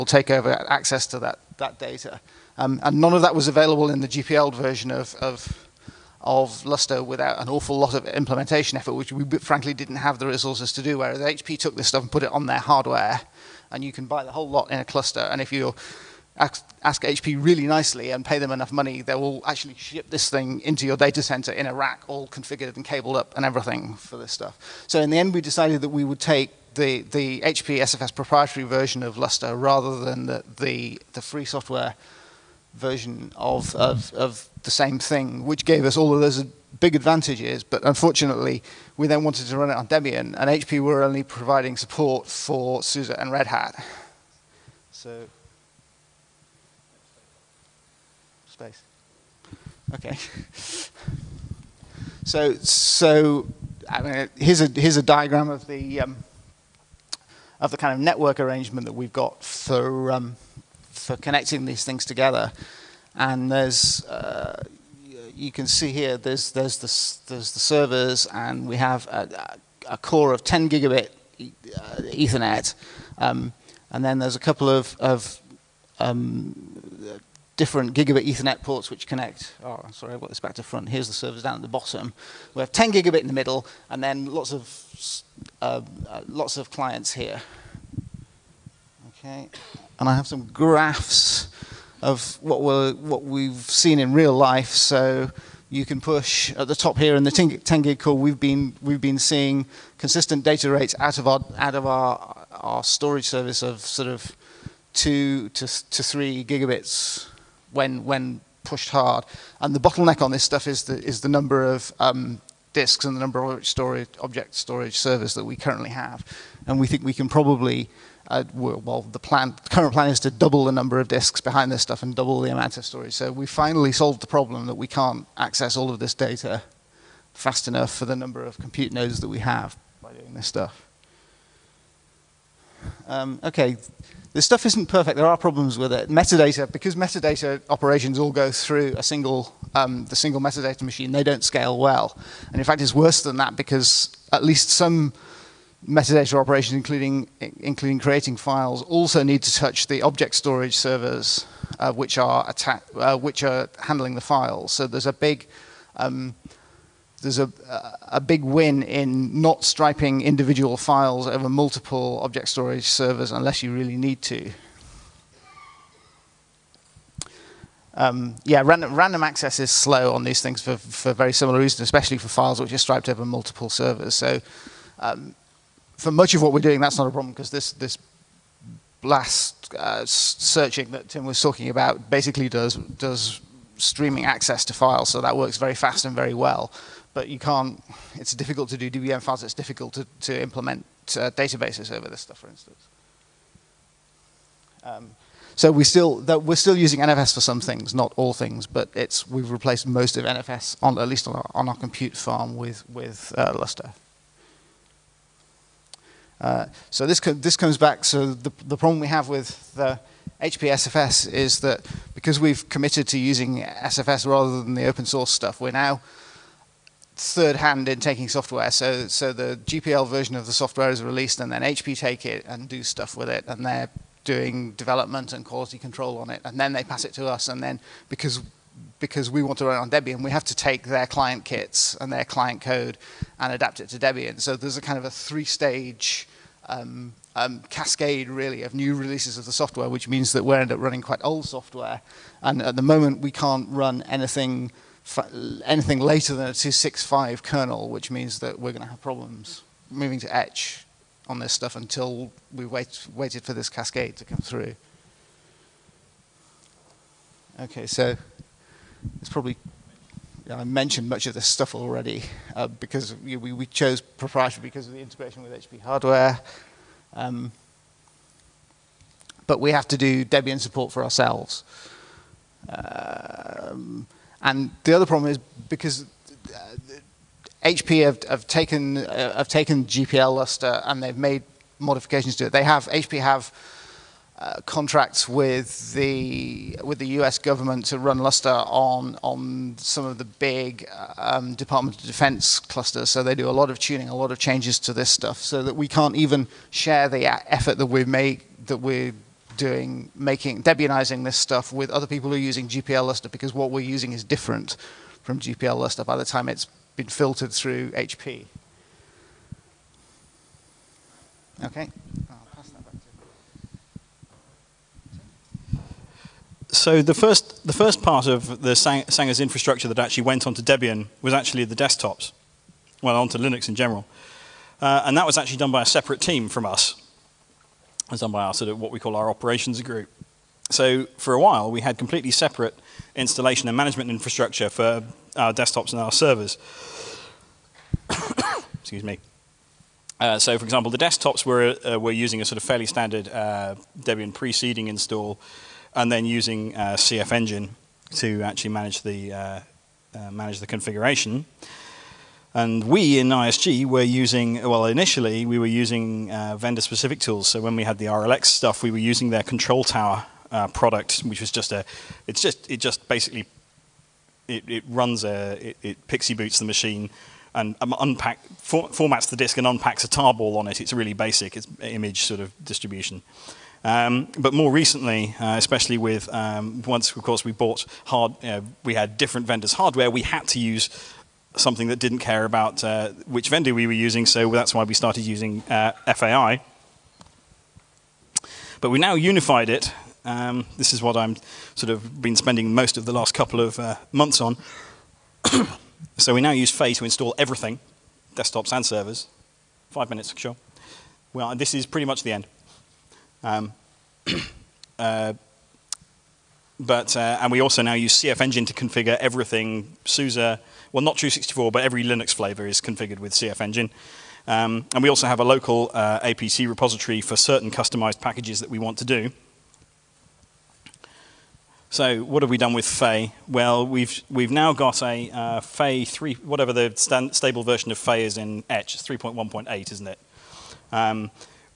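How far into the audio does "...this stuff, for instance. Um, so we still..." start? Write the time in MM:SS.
03:12.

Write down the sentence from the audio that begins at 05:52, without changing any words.
And we in ISG were using, well, initially we were using uh, vendor specific tools.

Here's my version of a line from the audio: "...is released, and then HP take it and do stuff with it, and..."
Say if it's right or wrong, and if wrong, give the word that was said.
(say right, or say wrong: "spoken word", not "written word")
right.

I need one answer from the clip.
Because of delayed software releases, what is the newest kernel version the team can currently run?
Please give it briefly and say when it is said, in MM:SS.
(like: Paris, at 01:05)
2.6.5, at 04:06.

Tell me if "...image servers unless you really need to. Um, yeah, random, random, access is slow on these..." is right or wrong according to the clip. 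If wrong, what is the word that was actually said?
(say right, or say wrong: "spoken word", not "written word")
wrong: "storage", not "image".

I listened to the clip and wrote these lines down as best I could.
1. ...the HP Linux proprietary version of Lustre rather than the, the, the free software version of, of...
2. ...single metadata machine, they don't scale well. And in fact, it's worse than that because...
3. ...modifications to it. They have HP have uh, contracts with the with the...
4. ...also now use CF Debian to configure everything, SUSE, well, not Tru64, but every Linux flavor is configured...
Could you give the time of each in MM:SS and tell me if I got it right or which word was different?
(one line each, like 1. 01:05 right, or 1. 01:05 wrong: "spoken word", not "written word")
1. 00:27 wrong: "SFS", not "Linux"
2. 02:20 right
3. 04:41 right
4. 06:47 wrong: "Engine", not "Debian".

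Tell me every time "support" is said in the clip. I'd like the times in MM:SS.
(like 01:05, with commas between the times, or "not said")
00:41, 04:30.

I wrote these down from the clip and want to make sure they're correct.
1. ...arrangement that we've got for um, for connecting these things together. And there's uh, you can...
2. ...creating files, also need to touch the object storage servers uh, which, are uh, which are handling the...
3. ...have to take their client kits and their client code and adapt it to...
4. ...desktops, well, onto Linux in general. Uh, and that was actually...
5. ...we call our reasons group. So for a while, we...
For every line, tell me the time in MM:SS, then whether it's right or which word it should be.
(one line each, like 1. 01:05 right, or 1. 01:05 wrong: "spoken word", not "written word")
1. 00:58 right
2. 02:27 right
3. 03:50 right
4. 05:21 right
5. 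05:28 wrong: "operations", not "reasons".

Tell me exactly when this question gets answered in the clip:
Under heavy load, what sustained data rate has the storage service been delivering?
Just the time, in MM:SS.
01:44.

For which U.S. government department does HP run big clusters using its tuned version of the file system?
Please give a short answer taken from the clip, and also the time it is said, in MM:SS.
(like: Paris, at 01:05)
Department of Defense, at 04:51.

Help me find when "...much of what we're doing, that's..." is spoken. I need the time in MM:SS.
02:56.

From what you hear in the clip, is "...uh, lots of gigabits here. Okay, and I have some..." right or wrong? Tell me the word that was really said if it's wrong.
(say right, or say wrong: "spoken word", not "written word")
wrong: "clients", not "gigabits".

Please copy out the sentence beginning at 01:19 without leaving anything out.
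Oh, sorry, I've got this back to front.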